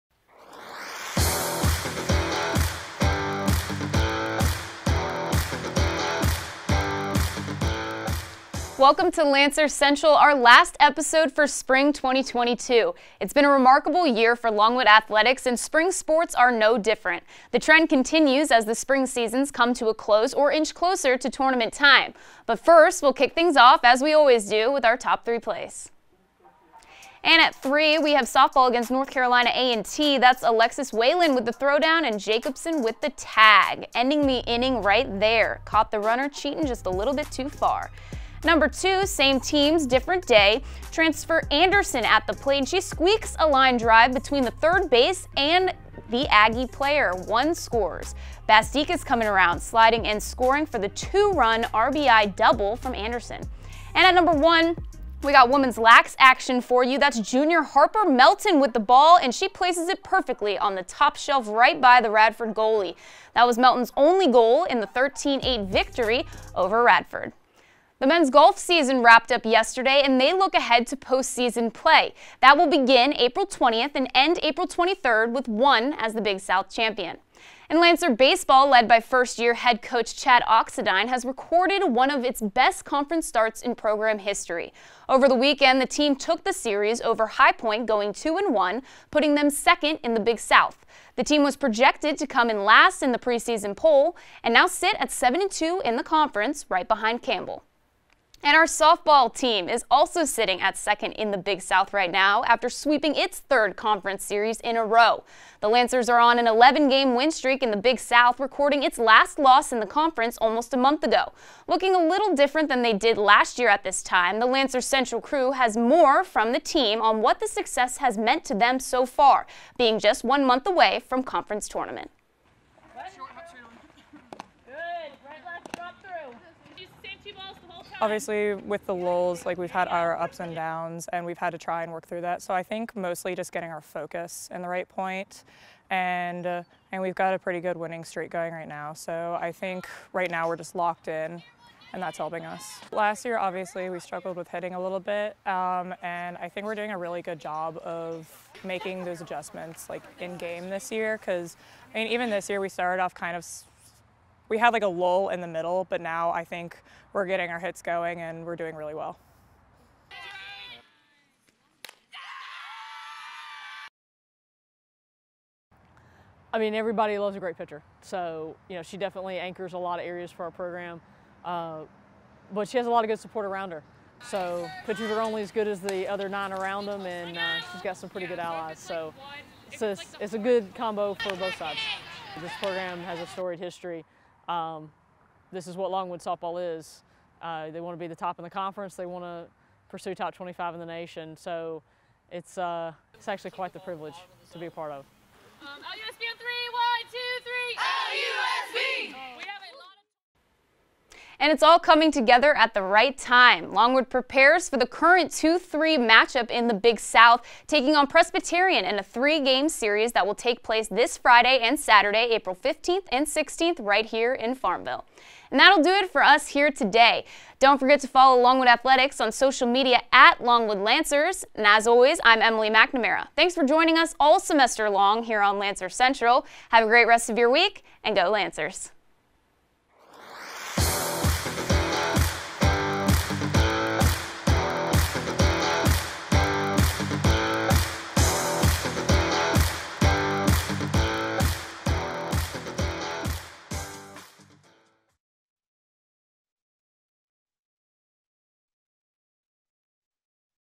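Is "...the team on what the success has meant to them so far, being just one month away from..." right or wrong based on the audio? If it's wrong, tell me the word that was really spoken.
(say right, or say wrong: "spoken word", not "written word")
right.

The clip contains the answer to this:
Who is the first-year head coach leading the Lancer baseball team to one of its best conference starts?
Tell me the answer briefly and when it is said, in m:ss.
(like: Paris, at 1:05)
Chad Oxendine, at 1:20.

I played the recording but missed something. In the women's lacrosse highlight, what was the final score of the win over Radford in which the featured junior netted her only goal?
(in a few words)
13-8.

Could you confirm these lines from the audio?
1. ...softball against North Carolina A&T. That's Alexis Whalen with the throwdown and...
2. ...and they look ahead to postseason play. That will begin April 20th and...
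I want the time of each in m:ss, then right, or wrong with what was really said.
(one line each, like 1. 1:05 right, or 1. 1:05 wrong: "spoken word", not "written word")
1. 0:28 right
2. 1:10 right.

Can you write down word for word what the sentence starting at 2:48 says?
So, you know, she definitely anchors a lot of areas for our program.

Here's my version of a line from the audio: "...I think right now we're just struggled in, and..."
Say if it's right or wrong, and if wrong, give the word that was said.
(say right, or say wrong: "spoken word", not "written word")
wrong: "locked", not "struggled".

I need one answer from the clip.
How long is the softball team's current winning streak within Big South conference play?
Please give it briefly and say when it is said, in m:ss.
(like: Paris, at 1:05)
11 games, at 1:46.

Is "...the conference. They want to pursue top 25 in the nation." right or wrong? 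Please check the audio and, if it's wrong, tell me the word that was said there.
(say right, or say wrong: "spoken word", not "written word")
right.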